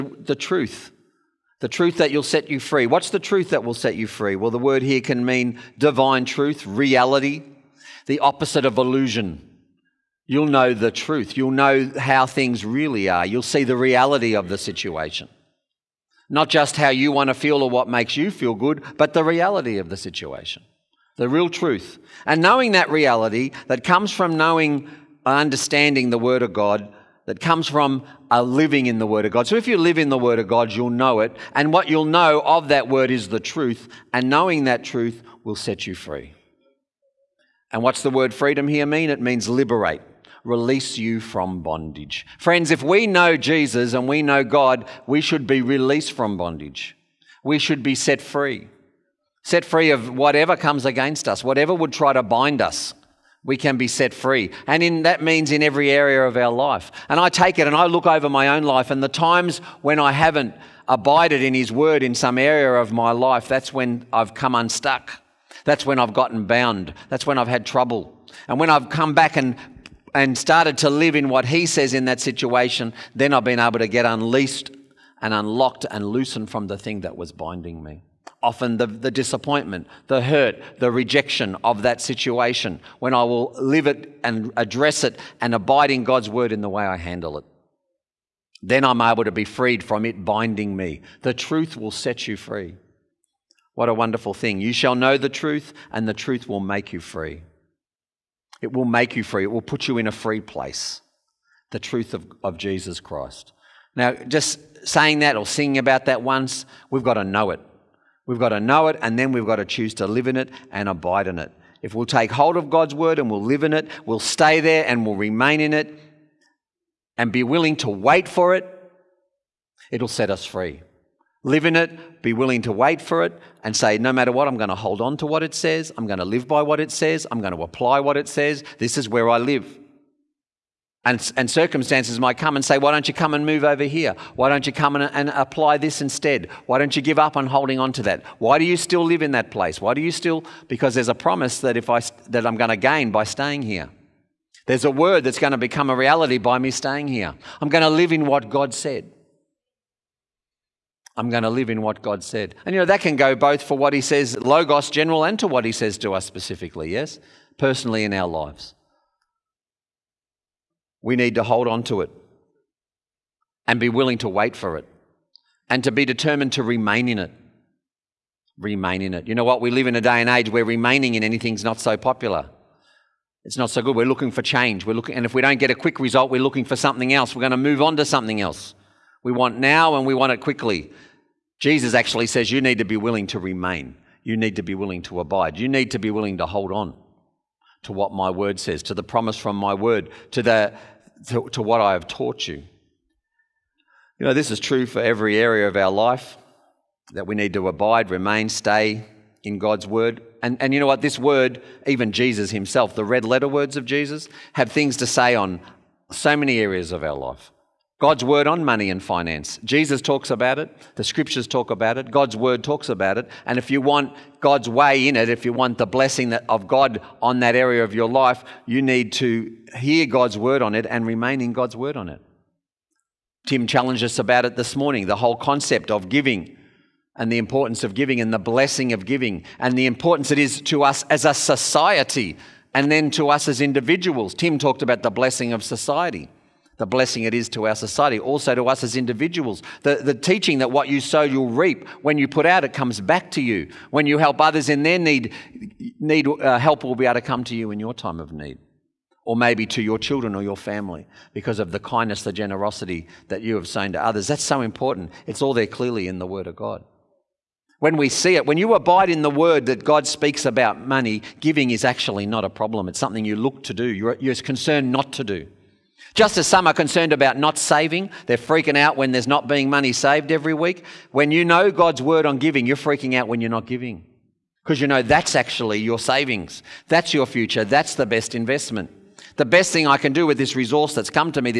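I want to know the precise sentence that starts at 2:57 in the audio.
We're going to move on to something else.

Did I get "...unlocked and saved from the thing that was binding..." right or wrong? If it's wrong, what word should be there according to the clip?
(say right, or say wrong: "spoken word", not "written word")
wrong: "loosened", not "saved".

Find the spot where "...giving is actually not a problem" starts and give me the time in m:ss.
4:21.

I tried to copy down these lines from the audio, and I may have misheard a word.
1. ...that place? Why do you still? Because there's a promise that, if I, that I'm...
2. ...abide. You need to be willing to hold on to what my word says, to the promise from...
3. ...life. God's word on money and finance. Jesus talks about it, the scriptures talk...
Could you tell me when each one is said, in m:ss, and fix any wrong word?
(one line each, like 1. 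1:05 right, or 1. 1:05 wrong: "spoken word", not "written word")
1. 2:19 right
2. 3:05 right
3. 3:27 right.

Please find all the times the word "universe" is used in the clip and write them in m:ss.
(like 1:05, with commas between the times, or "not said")
not said.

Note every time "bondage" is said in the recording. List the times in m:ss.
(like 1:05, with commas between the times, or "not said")
0:41, 0:46.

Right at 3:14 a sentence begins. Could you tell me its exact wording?
You know, this is true for every area of our life that we need to abide, remain, stay in God's word.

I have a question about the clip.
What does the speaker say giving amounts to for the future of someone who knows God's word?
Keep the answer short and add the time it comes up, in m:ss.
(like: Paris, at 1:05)
Your savings, at 4:35.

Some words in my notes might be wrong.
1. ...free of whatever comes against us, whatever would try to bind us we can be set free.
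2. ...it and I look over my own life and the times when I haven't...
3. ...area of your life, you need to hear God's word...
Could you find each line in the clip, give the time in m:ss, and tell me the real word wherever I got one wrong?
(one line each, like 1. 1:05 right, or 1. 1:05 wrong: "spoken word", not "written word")
1. 0:49 right
2. 0:57 right
3. 3:37 right.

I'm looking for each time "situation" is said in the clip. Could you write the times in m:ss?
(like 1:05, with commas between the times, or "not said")
0:14, 0:19, 1:12, 1:22.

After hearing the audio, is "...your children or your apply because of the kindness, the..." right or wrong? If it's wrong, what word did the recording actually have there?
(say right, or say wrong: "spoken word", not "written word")
wrong: "family", not "apply".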